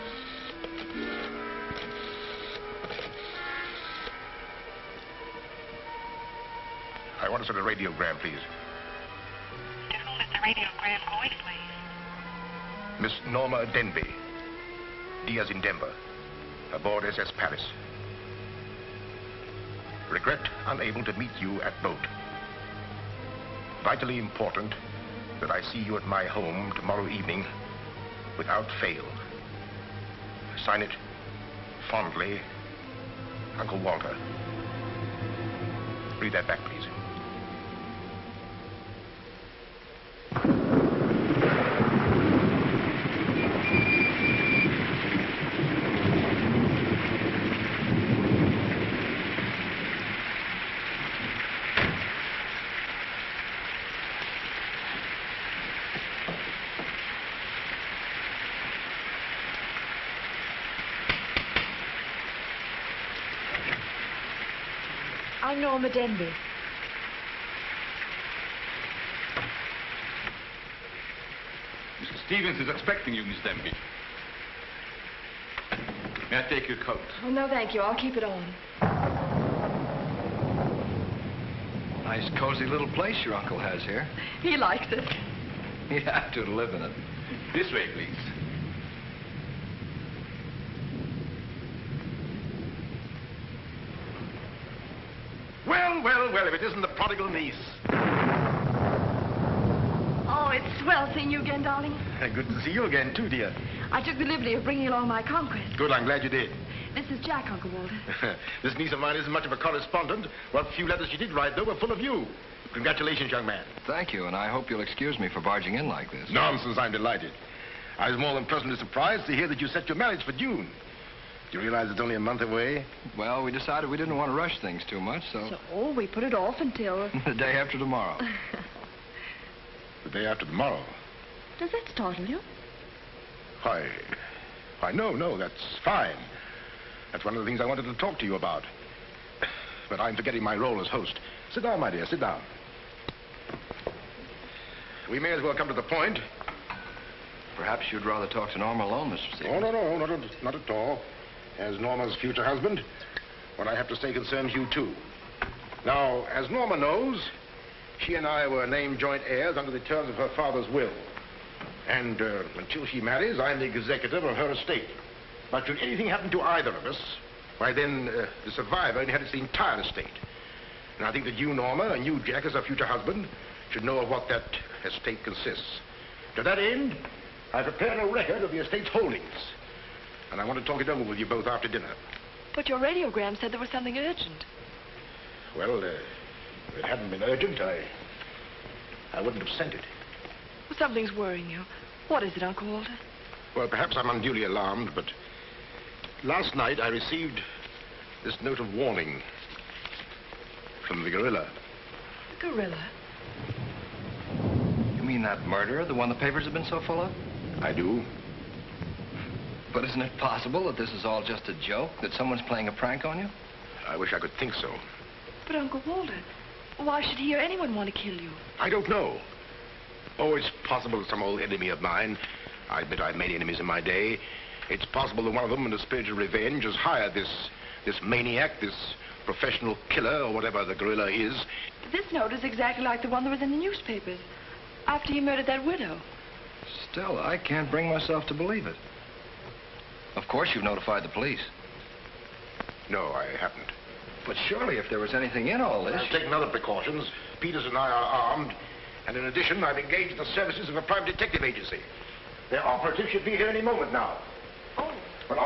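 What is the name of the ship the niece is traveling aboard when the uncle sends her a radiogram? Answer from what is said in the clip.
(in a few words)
SS Paris.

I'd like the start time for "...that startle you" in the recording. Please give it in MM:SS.
02:11.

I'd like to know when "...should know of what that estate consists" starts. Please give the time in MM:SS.
02:53.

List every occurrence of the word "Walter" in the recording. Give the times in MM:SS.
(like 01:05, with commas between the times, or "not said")
00:33, 01:47, 03:12, 03:35.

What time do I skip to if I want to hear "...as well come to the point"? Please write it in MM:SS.
02:25.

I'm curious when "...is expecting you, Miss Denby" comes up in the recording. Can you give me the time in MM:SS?
01:12.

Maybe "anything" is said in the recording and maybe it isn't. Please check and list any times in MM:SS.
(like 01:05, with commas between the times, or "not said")
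02:45, 04:05.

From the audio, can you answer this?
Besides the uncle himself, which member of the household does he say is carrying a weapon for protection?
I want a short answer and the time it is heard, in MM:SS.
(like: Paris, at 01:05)
Peters, at 04:07.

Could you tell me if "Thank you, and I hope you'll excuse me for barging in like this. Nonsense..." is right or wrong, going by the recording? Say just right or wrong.
right.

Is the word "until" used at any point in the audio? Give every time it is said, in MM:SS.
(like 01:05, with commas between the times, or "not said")
02:06, 02:42.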